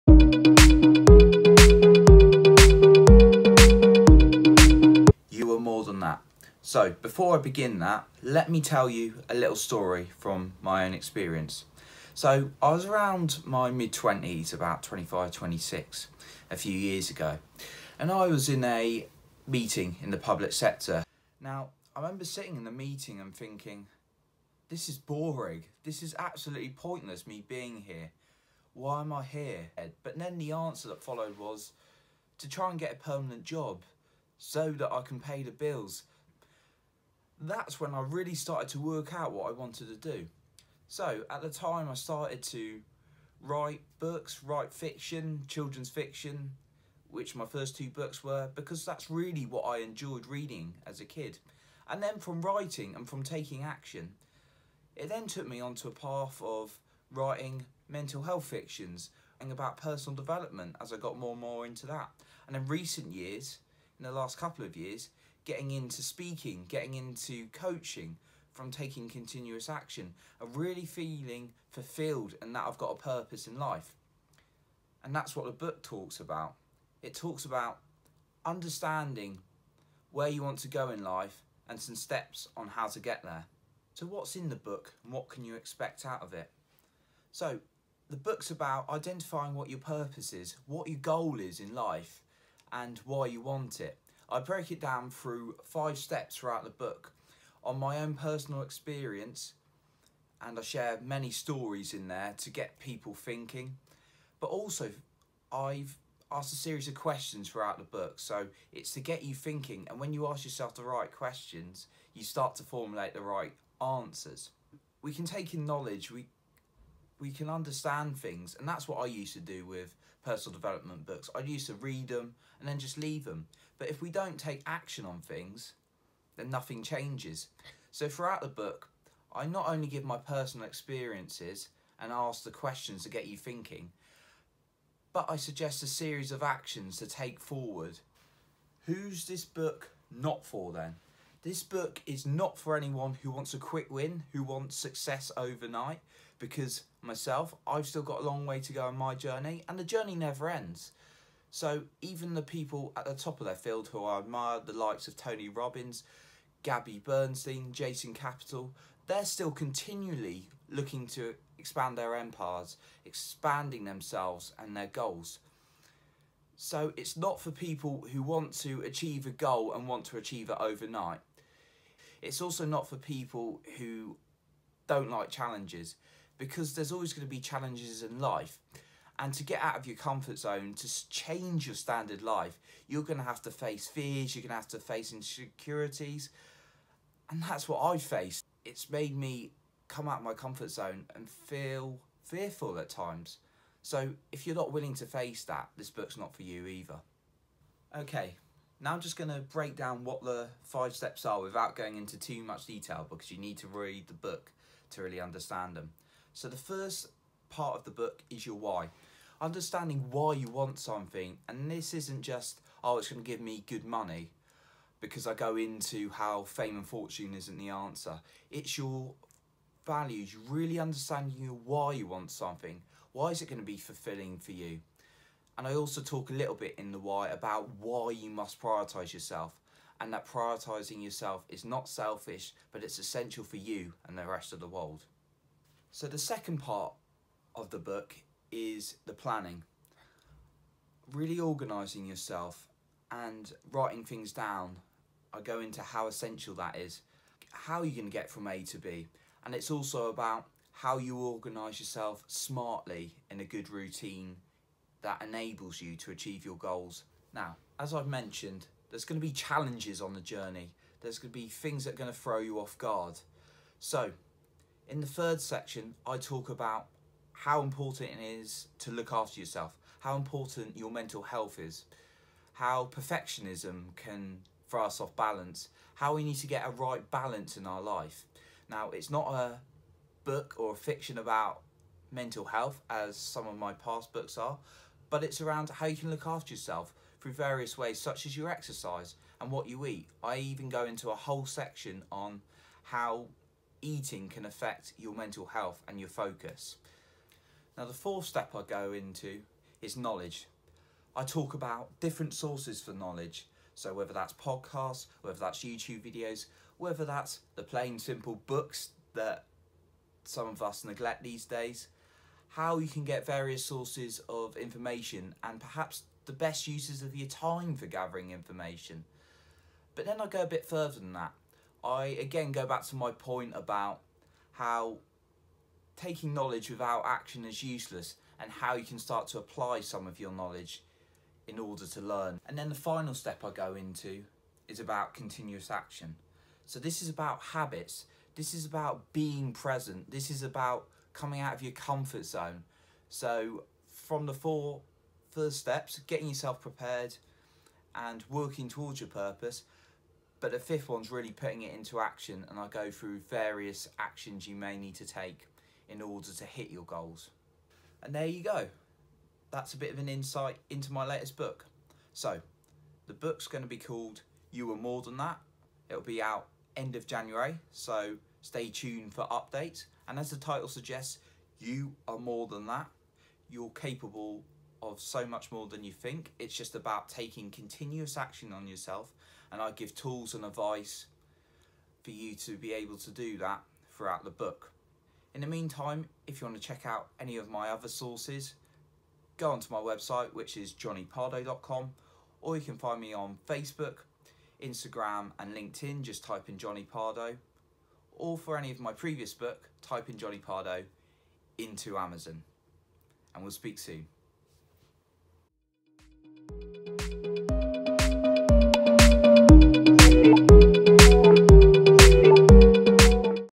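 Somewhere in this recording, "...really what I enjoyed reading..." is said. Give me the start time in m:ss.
0:49.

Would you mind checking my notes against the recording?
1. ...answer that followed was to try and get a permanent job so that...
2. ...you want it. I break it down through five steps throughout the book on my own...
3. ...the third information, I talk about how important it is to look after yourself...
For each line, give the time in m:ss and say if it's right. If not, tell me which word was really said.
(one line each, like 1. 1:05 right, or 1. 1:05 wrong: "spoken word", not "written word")
1. 0:30 right
2. 1:33 right
3. 4:25 wrong: "section", not "information".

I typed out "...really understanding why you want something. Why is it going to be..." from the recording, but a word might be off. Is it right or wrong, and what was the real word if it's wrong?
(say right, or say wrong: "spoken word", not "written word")
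right.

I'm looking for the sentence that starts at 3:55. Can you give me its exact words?
So, the second part of the book is the planning.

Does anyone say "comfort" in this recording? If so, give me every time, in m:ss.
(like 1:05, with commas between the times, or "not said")
2:59, 3:10, 5:41.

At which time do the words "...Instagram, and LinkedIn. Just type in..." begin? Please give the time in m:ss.
6:34.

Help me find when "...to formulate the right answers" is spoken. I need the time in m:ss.
1:52.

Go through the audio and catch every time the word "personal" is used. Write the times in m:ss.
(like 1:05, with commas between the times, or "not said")
0:59, 1:38, 2:00, 2:10.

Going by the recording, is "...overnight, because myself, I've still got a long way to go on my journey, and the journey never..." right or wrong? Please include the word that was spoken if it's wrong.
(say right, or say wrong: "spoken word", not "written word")
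right.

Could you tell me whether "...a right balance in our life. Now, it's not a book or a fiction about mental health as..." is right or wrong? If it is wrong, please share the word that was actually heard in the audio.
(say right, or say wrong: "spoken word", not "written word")
right.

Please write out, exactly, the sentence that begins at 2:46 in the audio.
So it's not for people who want to achieve a goal and want to achieve it overnight.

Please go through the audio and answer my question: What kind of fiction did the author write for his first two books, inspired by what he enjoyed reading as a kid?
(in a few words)
children's fiction.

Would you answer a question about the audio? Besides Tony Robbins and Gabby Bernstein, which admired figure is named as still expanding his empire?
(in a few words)
Jason Capital.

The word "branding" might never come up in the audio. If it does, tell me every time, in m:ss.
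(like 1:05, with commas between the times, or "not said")
not said.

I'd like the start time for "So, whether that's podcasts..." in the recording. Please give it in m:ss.
5:03.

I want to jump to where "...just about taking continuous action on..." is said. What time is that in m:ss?
6:16.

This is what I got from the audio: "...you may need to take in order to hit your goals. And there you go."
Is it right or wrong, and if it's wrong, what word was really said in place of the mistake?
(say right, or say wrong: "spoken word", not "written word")
right.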